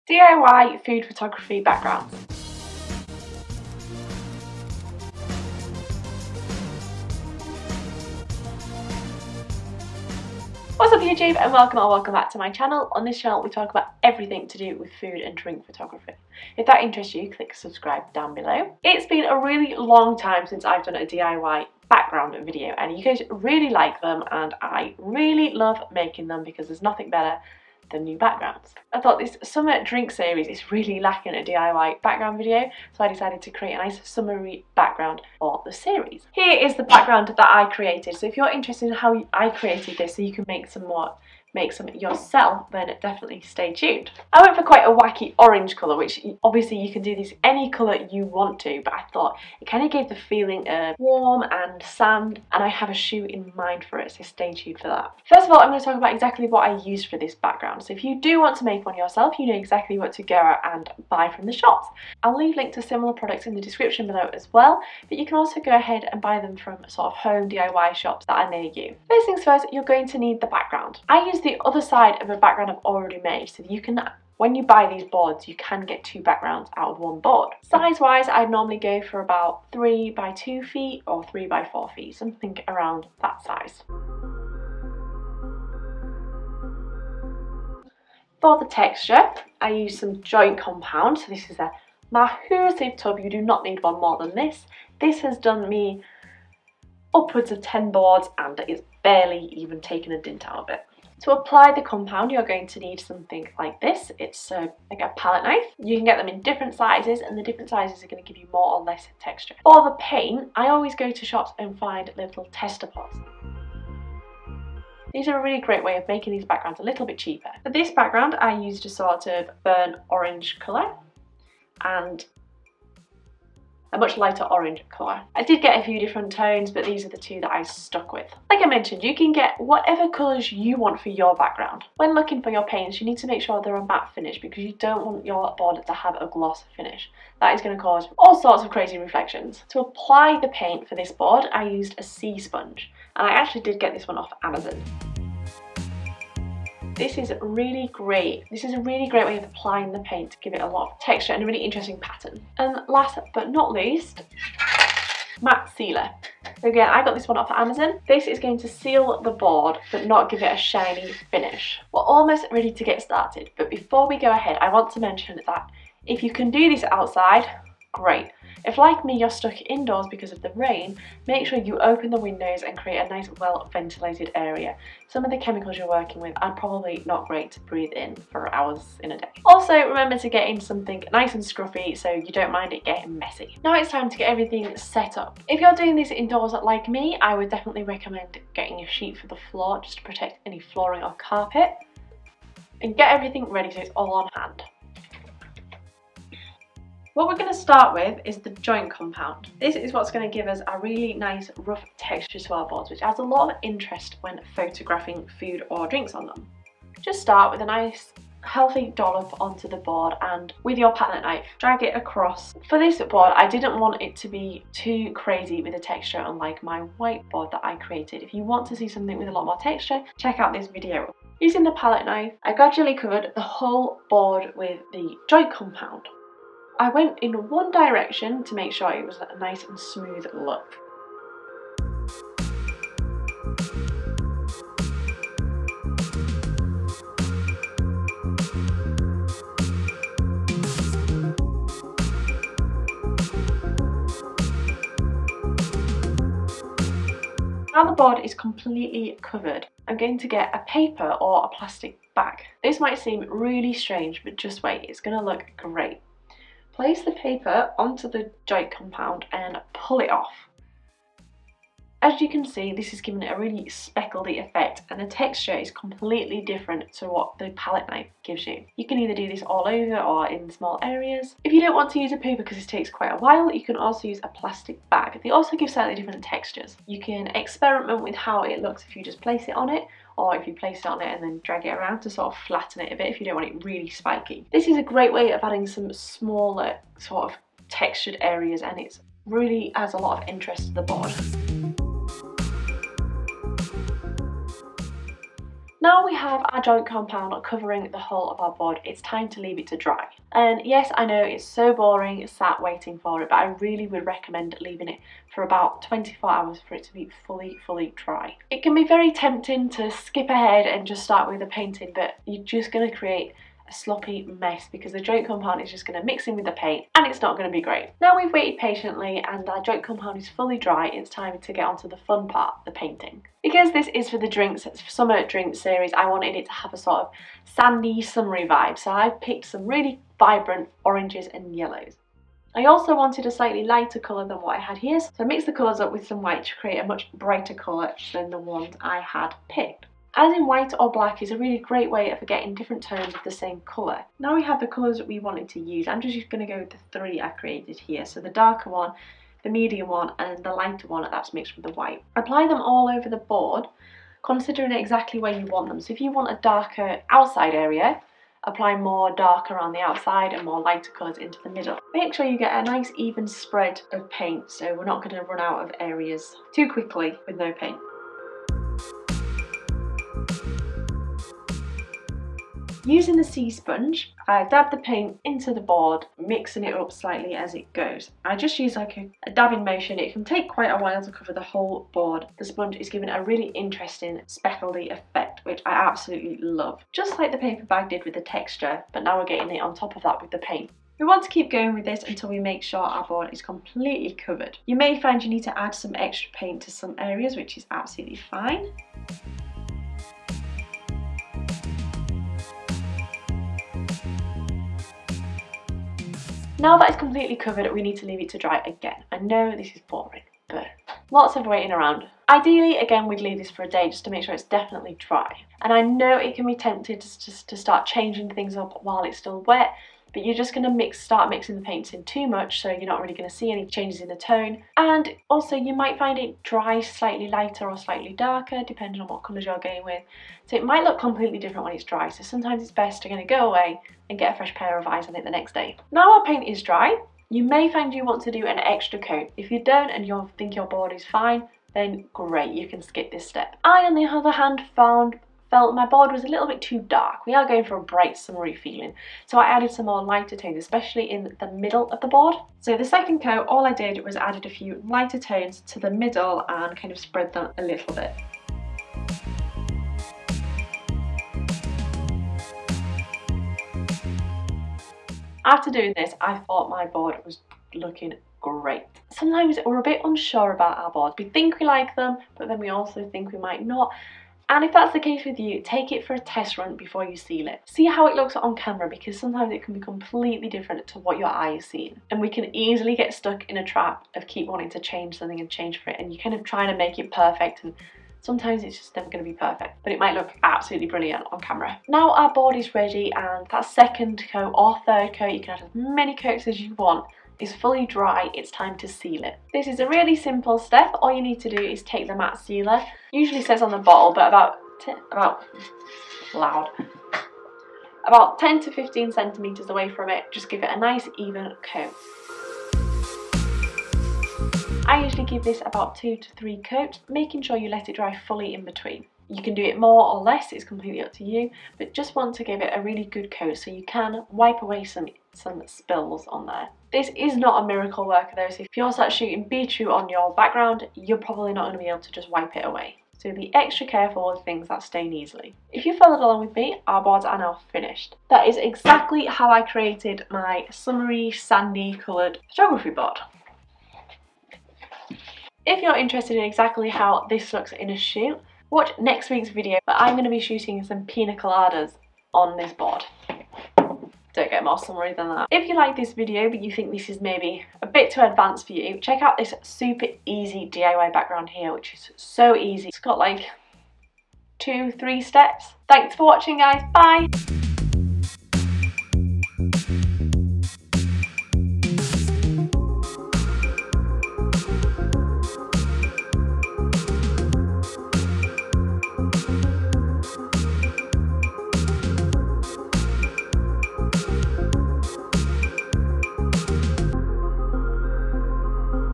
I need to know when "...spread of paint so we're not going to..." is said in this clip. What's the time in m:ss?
6:03.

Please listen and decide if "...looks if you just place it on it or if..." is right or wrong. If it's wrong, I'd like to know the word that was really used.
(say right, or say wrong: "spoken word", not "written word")
right.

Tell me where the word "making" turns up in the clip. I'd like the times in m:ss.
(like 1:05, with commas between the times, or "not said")
0:25, 1:56, 8:37.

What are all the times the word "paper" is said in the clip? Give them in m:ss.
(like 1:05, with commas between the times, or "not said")
4:10, 4:17, 6:27.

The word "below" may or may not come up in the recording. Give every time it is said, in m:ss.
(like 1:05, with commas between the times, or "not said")
0:18, 1:04.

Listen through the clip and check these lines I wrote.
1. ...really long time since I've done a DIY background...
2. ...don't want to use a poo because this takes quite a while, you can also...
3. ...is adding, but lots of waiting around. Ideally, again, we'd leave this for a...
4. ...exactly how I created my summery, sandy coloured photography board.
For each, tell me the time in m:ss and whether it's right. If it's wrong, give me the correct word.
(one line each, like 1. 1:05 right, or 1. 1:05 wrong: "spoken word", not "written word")
1. 0:19 right
2. 4:31 right
3. 6:49 wrong: "boring", not "adding"
4. 8:58 right.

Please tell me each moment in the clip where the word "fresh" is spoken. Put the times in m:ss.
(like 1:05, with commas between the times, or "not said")
7:14.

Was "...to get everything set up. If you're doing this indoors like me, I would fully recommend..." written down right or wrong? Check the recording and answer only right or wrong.
wrong.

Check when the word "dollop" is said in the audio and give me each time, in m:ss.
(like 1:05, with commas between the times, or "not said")
3:28.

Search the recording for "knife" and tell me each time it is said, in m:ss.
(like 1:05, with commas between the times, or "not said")
1:45, 3:31, 3:42, 4:27.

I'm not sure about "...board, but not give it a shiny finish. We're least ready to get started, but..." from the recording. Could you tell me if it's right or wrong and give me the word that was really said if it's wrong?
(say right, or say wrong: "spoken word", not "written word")
wrong: "almost", not "least".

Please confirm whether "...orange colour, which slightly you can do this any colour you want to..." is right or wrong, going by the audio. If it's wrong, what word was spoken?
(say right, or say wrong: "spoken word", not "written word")
wrong: "obviously", not "slightly".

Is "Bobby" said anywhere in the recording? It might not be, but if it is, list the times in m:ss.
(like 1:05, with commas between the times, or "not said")
not said.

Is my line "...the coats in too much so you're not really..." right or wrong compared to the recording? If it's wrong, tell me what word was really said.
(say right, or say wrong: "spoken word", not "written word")
wrong: "paints", not "coats".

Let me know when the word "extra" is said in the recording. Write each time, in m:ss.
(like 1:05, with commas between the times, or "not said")
6:35, 7:18, 8:53.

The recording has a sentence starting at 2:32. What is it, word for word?
And um, last but not least, matte sealer.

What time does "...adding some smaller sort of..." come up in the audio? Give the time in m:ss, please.
4:45.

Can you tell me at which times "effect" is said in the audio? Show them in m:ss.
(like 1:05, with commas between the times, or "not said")
4:24, 6:24.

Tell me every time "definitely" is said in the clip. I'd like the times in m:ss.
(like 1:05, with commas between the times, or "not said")
0:43, 3:07, 6:54.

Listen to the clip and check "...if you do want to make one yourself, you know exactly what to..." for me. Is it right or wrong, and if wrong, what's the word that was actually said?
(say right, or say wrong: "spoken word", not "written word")
right.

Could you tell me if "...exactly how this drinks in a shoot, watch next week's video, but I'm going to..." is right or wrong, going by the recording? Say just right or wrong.
wrong.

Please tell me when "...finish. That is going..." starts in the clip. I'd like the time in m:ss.
2:16.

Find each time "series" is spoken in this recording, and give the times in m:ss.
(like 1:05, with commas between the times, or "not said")
0:30, 0:35, 5:25.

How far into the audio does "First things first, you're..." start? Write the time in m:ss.
1:09.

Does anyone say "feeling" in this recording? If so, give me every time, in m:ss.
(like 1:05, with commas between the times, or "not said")
0:50, 7:28.